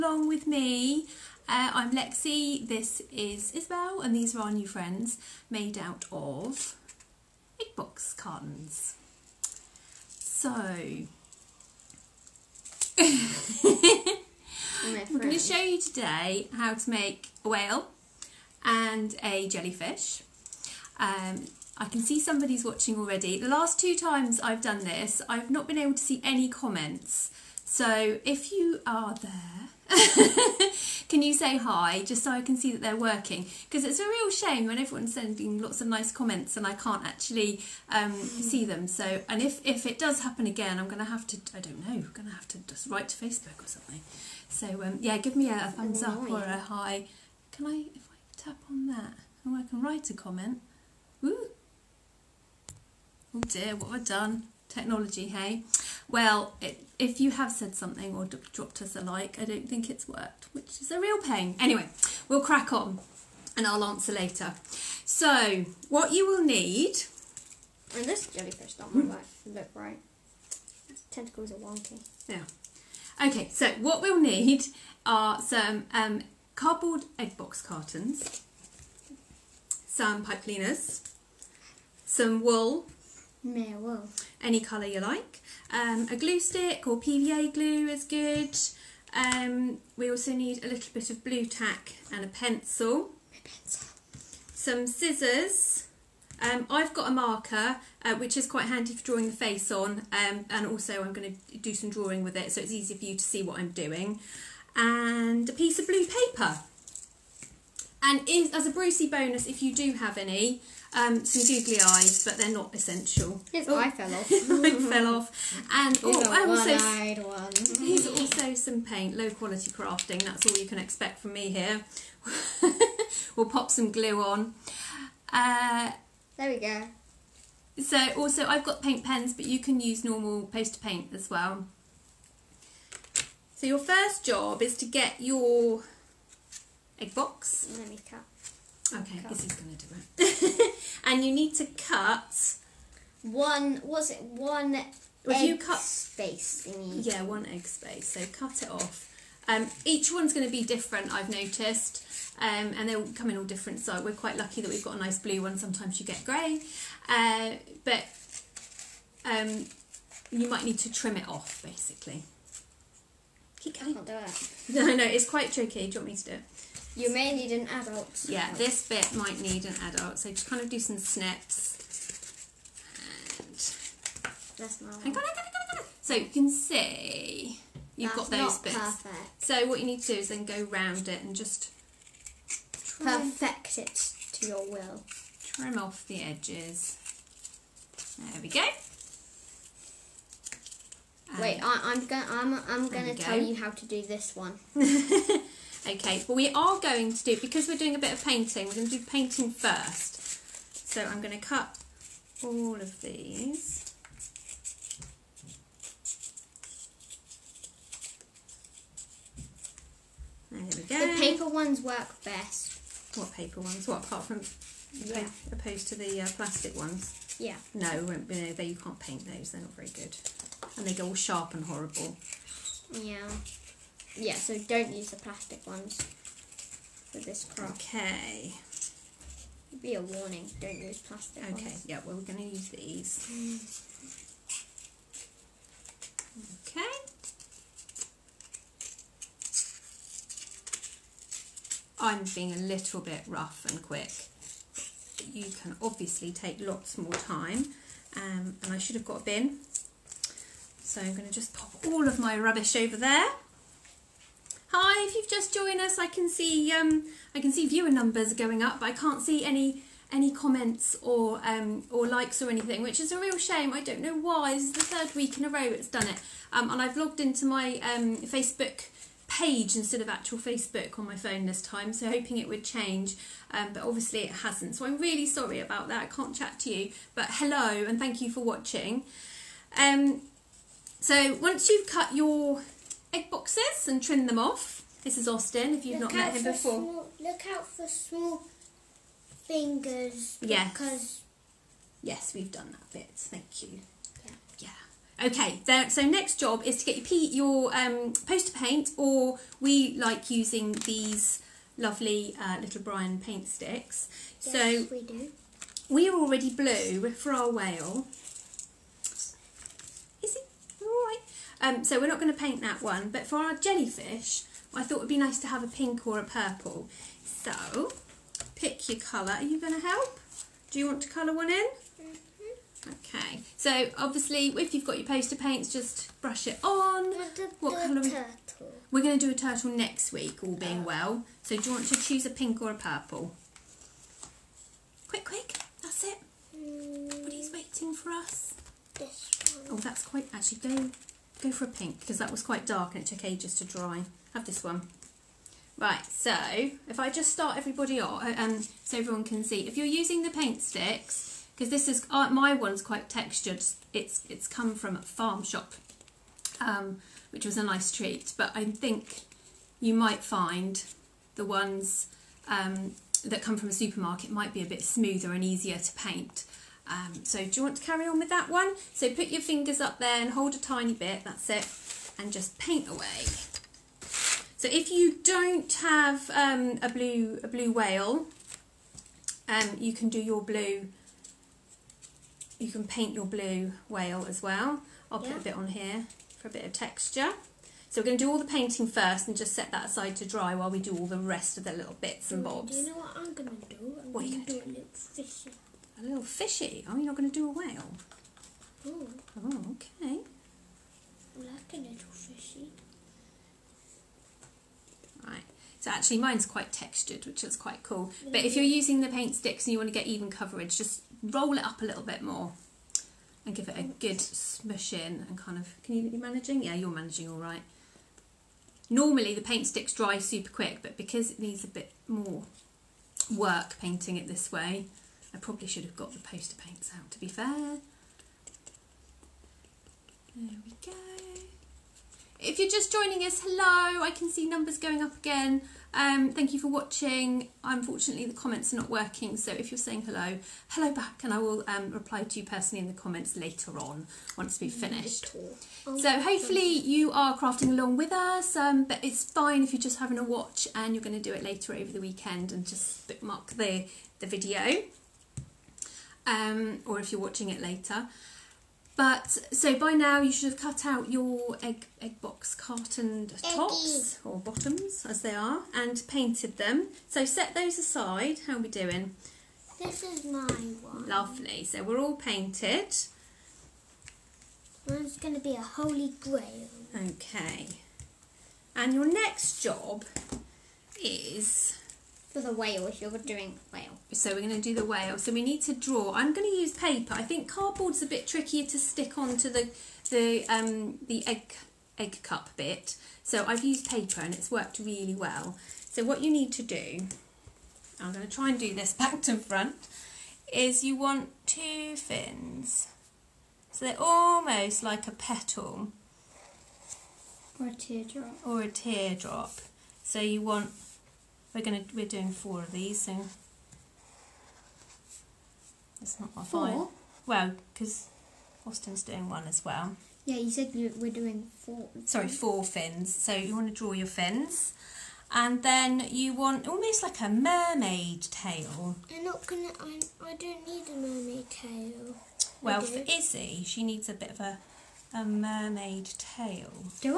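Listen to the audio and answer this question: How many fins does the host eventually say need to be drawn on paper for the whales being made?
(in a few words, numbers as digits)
4.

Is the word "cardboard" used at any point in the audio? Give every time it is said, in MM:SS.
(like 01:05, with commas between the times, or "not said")
01:16, 08:07.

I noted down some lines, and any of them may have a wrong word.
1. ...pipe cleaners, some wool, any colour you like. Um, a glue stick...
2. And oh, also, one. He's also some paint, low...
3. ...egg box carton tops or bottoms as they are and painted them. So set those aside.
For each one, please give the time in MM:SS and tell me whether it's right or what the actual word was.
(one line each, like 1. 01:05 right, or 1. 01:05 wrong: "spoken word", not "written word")
1. 01:20 right
2. 01:55 right
3. 07:41 right.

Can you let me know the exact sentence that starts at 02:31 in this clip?
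I've noticed, um, and they'll come in all different.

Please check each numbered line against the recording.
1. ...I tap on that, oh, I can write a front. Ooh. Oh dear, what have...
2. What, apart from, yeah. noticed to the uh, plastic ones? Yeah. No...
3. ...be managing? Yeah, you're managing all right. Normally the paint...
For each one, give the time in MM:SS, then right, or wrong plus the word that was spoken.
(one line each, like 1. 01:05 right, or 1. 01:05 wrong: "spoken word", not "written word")
1. 00:48 wrong: "comment", not "front"
2. 03:33 wrong: "opposed", not "noticed"
3. 06:56 right.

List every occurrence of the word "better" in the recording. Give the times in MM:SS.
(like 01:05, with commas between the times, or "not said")
not said.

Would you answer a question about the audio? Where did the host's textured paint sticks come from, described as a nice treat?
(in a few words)
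A farm shop.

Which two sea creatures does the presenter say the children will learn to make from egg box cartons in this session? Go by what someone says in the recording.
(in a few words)
A whale and a jellyfish.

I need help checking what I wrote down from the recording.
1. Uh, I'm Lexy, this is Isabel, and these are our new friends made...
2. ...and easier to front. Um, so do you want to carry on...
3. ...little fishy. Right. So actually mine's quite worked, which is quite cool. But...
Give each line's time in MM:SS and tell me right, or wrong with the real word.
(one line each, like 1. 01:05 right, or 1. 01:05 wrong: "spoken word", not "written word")
1. 00:01 right
2. 06:05 wrong: "paint", not "front"
3. 06:41 wrong: "textured", not "worked".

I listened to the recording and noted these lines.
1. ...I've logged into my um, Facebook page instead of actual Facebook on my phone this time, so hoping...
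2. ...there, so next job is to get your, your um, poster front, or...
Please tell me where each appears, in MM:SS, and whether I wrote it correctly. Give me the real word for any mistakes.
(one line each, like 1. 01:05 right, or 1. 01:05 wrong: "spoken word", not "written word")
1. 04:26 right
2. 04:55 wrong: "paint", not "front".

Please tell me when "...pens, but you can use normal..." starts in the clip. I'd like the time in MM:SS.
02:09.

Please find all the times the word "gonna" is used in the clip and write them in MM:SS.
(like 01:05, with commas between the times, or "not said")
08:31, 08:49.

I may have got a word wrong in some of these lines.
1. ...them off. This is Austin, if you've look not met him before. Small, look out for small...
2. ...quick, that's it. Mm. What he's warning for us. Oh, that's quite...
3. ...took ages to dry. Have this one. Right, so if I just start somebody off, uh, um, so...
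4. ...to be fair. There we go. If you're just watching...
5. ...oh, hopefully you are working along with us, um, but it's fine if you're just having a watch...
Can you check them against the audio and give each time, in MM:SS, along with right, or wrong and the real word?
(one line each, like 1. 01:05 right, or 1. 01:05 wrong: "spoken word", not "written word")
1. 04:44 right
2. 05:35 wrong: "waiting", not "warning"
3. 05:43 wrong: "everybody", not "somebody"
4. 07:07 wrong: "joining", not "watching"
5. 07:25 wrong: "crafting", not "working".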